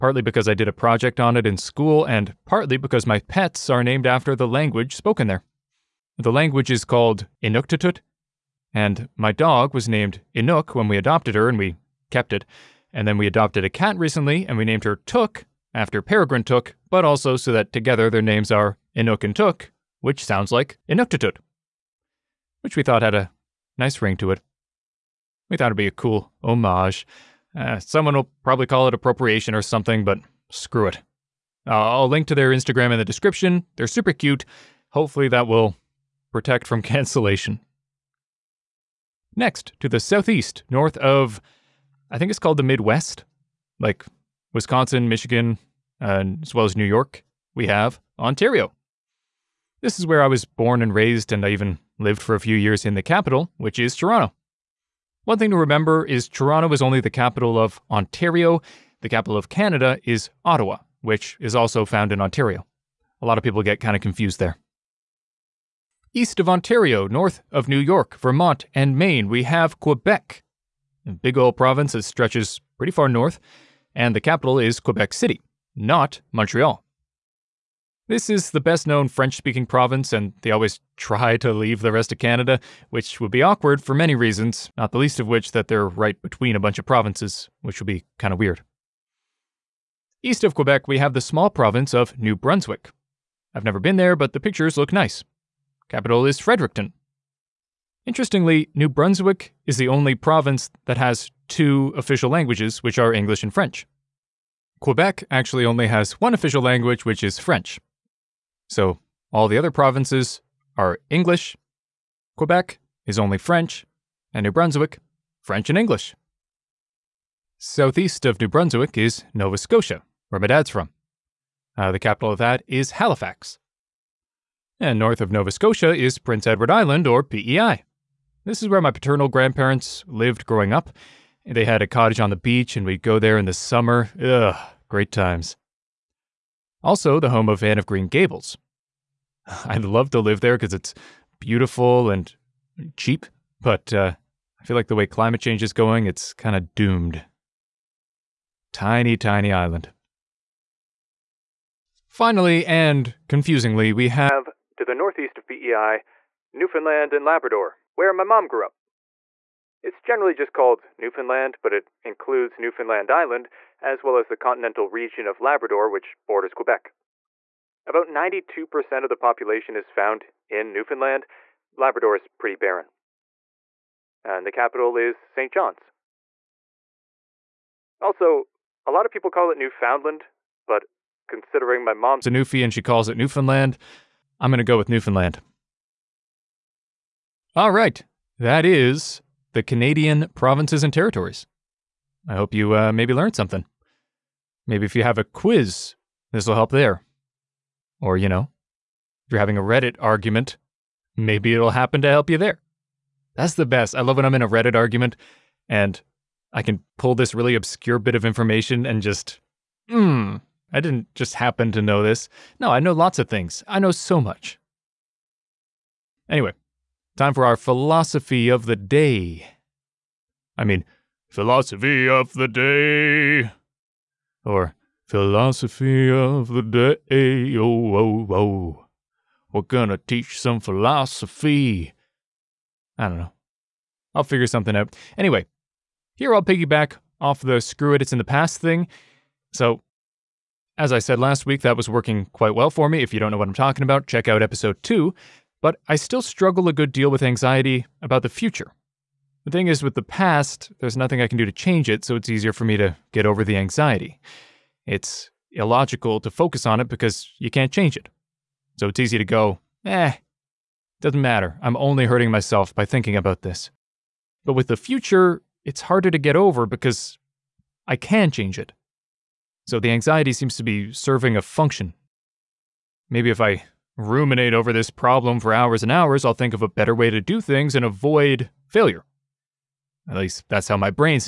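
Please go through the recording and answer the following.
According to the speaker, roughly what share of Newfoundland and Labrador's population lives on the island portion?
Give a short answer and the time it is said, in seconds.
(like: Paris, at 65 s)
92%, at 168 s.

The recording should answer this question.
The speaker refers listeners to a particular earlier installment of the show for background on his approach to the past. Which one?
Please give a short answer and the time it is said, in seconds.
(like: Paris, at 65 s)
Episode 2, at 244 s.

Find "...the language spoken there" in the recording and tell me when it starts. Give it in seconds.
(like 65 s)
4 s.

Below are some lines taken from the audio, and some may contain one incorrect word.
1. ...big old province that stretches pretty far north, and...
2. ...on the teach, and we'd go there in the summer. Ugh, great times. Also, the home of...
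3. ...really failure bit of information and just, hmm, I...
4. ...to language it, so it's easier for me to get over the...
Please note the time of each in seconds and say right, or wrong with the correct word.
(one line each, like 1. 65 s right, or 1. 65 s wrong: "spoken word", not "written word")
1. 71 s right
2. 132 s wrong: "beach", not "teach"
3. 207 s wrong: "obscure", not "failure"
4. 251 s wrong: "change", not "language".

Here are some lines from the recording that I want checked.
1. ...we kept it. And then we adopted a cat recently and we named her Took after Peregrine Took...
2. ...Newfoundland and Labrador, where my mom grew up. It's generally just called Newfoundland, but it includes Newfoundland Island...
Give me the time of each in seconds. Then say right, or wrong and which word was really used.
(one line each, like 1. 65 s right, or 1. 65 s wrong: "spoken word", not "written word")
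1. 11 s right
2. 156 s right.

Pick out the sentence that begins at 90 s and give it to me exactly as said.
East of Quebec, we have the small province of New Brunswick.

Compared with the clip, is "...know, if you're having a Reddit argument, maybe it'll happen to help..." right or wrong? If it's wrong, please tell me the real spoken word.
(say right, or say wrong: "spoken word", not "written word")
right.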